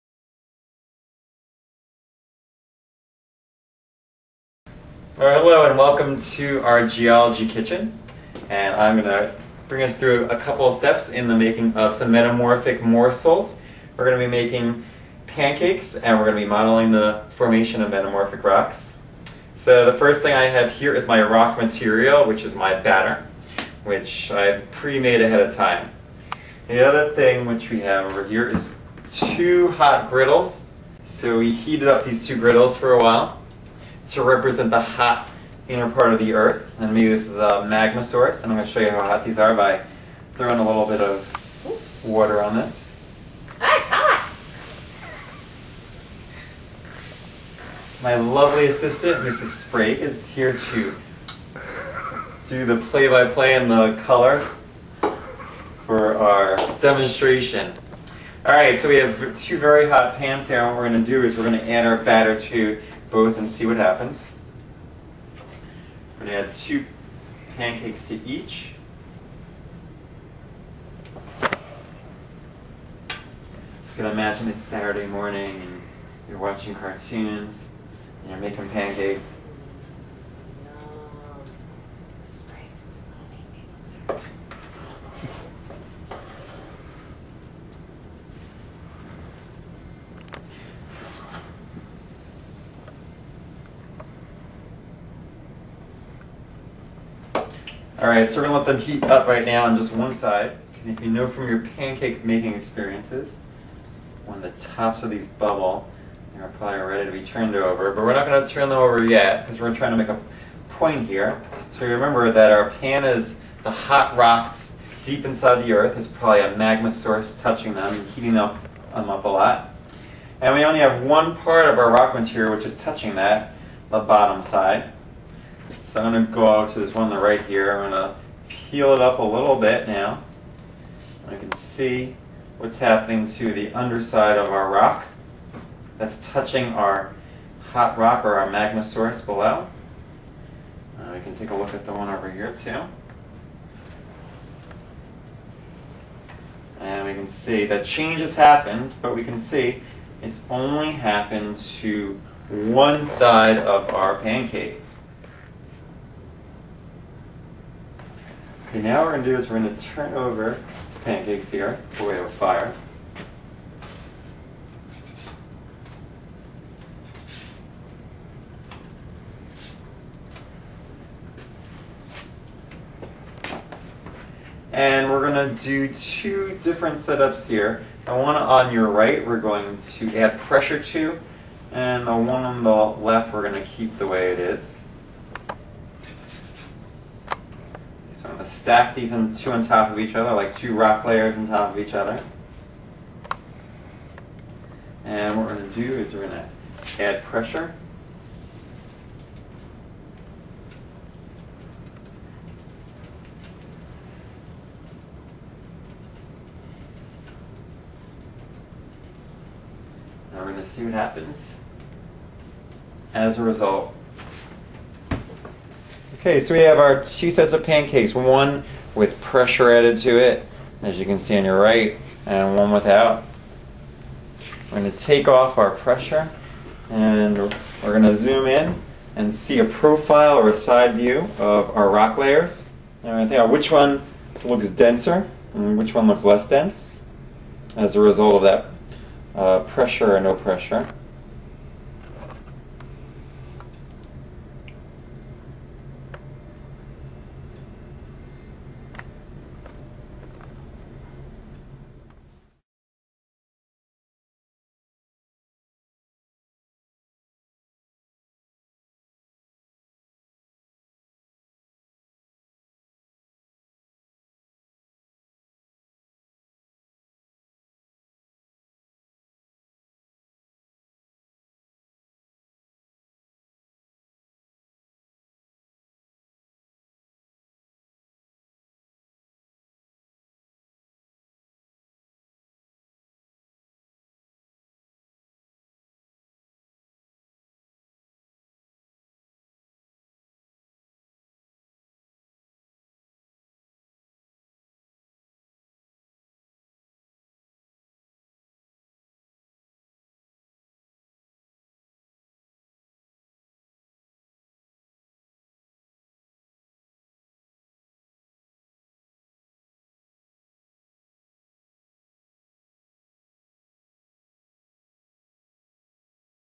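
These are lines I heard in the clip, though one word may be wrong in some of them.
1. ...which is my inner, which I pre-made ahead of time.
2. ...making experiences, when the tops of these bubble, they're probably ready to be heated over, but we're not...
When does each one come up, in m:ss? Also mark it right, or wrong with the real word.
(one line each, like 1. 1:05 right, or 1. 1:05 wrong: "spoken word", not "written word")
1. 0:22 wrong: "batter", not "inner"
2. 1:42 wrong: "turned", not "heated".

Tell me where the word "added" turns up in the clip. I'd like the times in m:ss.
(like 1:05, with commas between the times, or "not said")
3:39.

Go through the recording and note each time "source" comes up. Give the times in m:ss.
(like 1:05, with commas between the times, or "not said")
0:38, 1:56, 2:18.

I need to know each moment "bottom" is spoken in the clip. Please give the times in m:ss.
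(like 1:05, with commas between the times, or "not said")
2:03.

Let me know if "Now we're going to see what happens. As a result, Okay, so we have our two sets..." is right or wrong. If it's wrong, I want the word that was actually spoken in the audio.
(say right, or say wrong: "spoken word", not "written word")
right.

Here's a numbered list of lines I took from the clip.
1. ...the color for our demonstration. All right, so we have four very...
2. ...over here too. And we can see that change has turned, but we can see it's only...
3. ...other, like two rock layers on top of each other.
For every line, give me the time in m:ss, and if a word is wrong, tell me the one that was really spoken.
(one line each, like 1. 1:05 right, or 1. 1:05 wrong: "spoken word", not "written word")
1. 0:53 wrong: "two", not "four"
2. 2:22 wrong: "happened", not "turned"
3. 3:10 right.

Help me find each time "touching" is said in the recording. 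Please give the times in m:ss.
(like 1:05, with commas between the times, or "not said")
1:57, 2:02, 2:16.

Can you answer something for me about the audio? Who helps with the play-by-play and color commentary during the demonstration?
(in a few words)
Mrs. Sprague.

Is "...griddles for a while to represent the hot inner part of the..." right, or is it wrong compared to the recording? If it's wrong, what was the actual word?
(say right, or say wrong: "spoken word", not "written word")
right.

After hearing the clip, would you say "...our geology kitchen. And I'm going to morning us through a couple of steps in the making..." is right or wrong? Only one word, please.
wrong.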